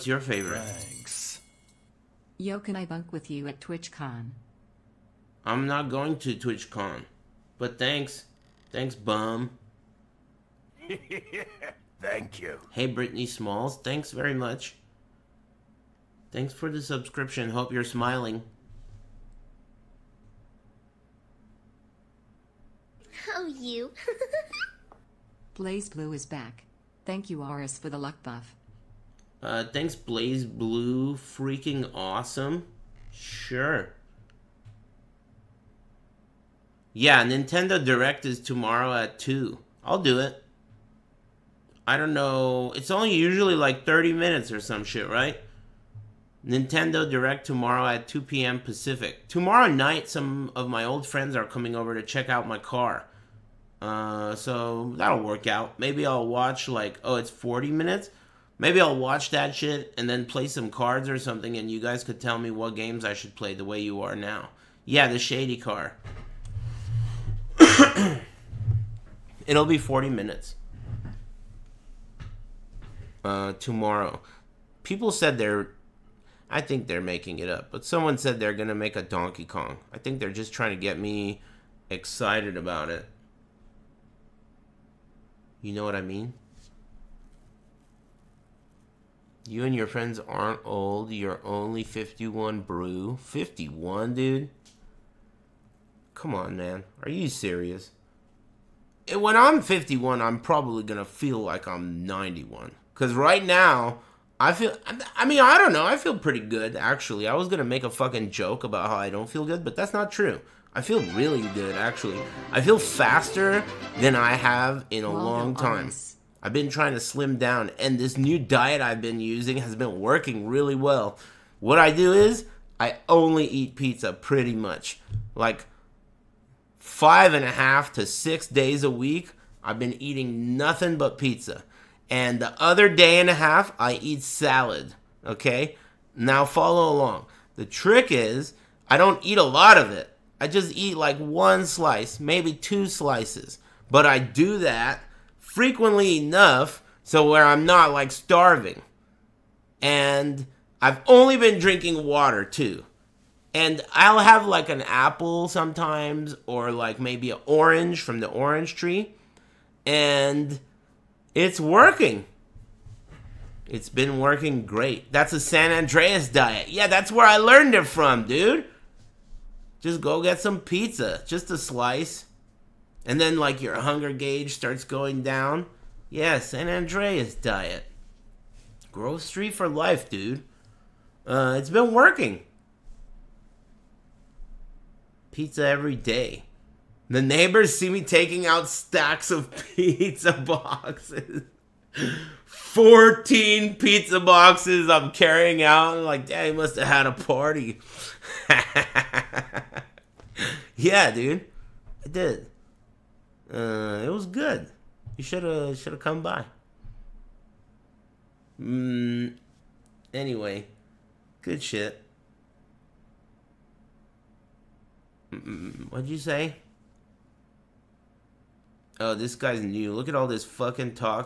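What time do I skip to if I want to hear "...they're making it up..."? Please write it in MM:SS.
01:16.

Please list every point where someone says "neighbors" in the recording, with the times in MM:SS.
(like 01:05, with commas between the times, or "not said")
03:07.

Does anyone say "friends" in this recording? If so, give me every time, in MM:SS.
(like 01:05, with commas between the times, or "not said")
00:51, 01:29.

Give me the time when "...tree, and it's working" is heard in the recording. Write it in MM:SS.
02:38.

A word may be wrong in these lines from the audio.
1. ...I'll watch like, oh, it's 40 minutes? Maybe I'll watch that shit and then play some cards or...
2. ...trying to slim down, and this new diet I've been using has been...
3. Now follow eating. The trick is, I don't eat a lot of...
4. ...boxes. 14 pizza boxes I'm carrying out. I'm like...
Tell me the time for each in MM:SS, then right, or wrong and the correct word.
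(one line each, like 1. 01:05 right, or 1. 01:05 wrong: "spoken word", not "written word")
1. 00:56 right
2. 01:56 right
3. 02:16 wrong: "along", not "eating"
4. 03:10 right.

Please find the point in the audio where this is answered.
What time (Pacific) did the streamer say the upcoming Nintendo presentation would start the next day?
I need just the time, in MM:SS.
00:48.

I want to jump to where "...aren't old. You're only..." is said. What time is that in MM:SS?
01:30.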